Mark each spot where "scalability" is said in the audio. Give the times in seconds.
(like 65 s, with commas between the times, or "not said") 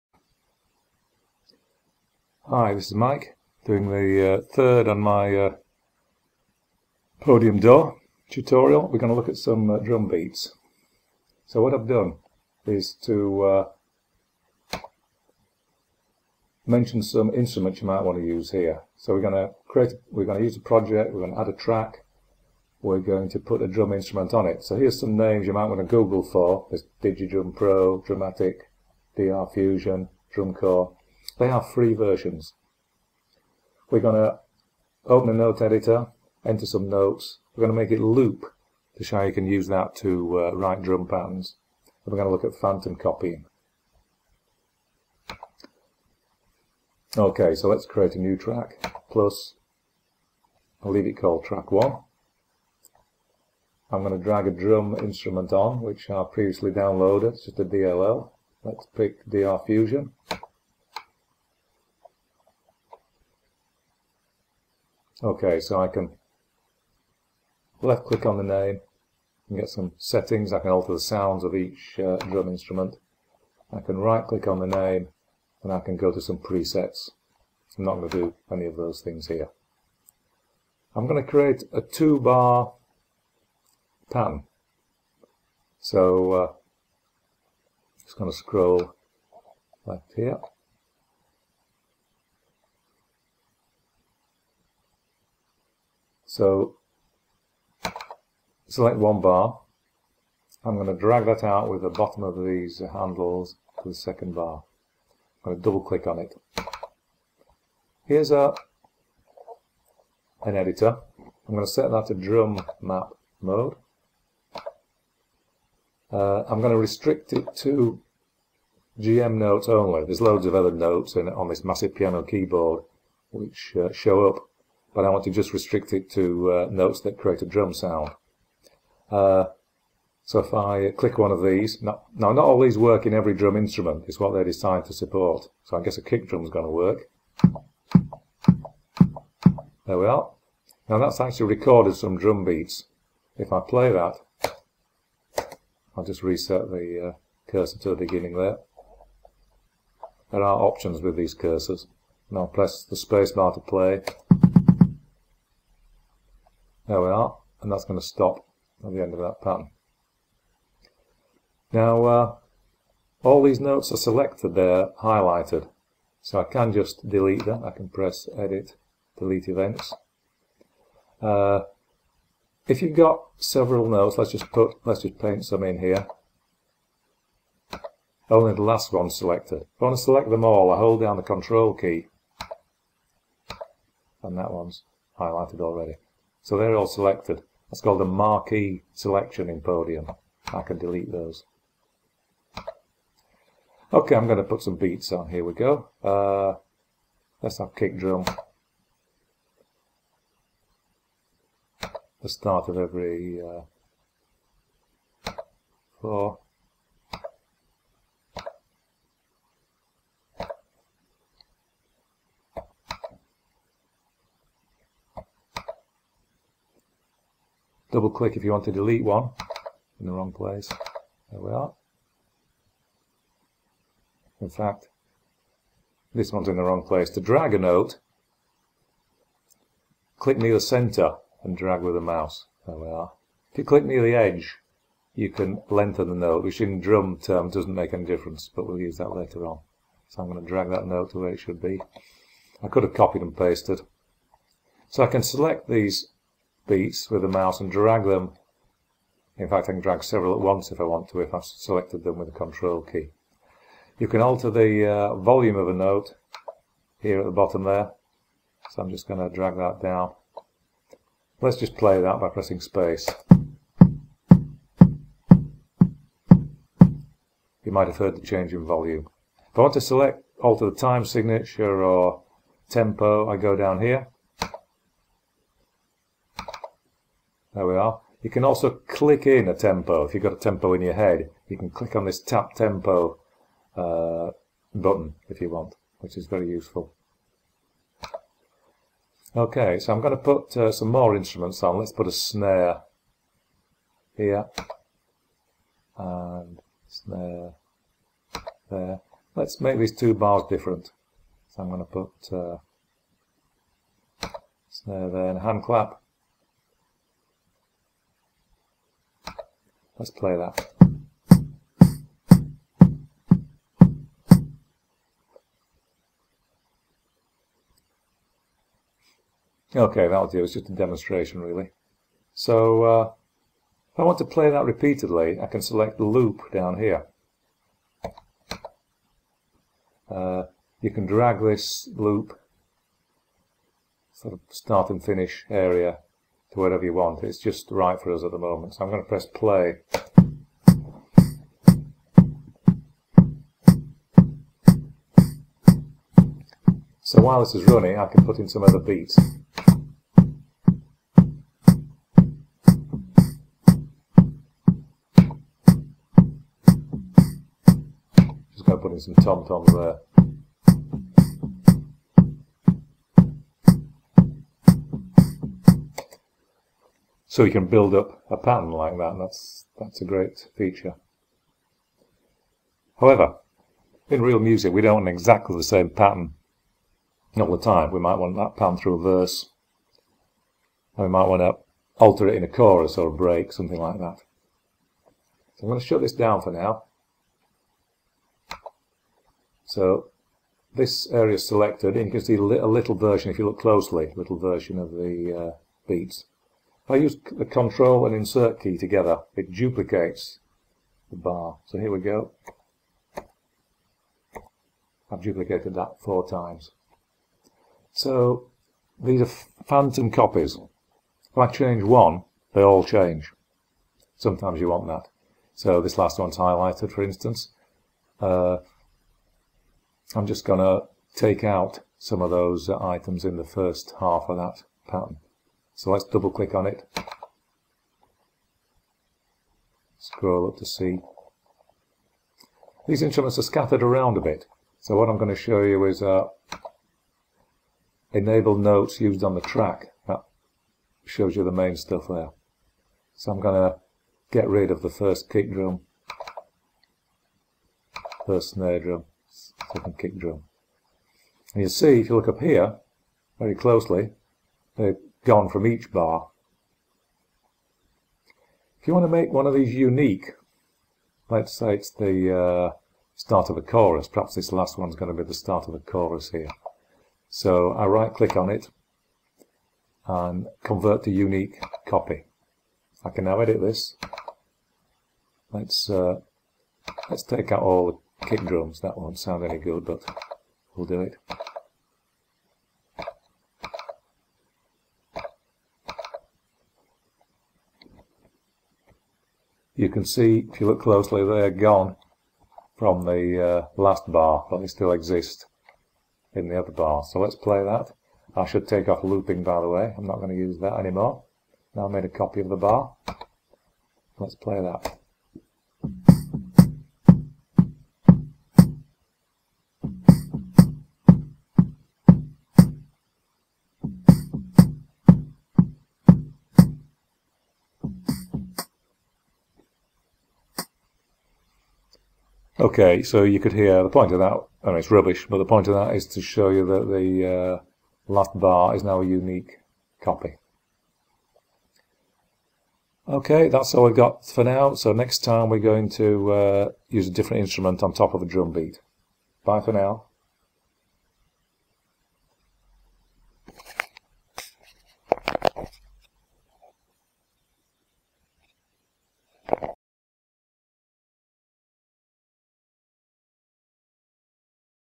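not said.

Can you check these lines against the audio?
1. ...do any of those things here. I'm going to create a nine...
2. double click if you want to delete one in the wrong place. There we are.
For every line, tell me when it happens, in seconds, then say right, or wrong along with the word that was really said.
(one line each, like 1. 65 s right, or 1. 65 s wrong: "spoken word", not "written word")
1. 78 s wrong: "two", not "nine"
2. 217 s right.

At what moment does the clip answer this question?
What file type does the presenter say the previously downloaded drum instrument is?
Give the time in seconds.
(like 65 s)
57 s.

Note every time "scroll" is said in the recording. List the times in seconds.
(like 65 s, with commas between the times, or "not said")
88 s, 429 s.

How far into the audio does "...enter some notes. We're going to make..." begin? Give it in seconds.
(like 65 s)
36 s.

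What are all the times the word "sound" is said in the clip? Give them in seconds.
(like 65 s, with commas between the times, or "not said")
70 s, 127 s, 479 s.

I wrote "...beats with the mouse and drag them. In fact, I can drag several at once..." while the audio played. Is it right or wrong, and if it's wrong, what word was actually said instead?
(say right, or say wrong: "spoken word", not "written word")
right.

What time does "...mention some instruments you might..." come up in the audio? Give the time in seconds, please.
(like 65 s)
16 s.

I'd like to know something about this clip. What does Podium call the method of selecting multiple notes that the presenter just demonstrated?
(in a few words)
Marquee selection.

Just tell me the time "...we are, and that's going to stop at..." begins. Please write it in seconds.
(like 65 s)
157 s.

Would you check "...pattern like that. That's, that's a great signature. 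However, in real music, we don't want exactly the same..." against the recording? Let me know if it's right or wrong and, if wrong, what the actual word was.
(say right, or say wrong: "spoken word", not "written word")
wrong: "feature", not "signature".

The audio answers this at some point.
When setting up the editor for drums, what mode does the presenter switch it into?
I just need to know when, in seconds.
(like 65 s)
112 s.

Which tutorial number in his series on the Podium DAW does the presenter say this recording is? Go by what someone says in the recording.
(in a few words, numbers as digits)
Third.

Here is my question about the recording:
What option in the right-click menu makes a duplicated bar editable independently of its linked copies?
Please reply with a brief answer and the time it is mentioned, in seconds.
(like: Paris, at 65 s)
Convert to unique copy, at 470 s.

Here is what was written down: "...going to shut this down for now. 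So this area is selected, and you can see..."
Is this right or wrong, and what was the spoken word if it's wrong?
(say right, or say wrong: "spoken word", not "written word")
right.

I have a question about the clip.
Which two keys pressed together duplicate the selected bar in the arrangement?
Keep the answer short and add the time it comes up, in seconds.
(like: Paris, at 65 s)
Control and Insert, at 397 s.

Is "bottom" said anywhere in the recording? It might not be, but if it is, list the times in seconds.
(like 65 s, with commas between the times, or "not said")
101 s, 257 s.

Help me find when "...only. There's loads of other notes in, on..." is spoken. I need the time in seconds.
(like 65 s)
119 s.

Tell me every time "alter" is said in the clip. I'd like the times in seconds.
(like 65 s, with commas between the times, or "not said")
70 s, 254 s, 270 s, 382 s.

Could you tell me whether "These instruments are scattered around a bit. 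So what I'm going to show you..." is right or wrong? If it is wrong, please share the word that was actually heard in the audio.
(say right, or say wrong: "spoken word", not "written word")
right.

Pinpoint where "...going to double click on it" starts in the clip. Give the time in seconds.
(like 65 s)
105 s.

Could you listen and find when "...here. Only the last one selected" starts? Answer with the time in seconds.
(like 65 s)
175 s.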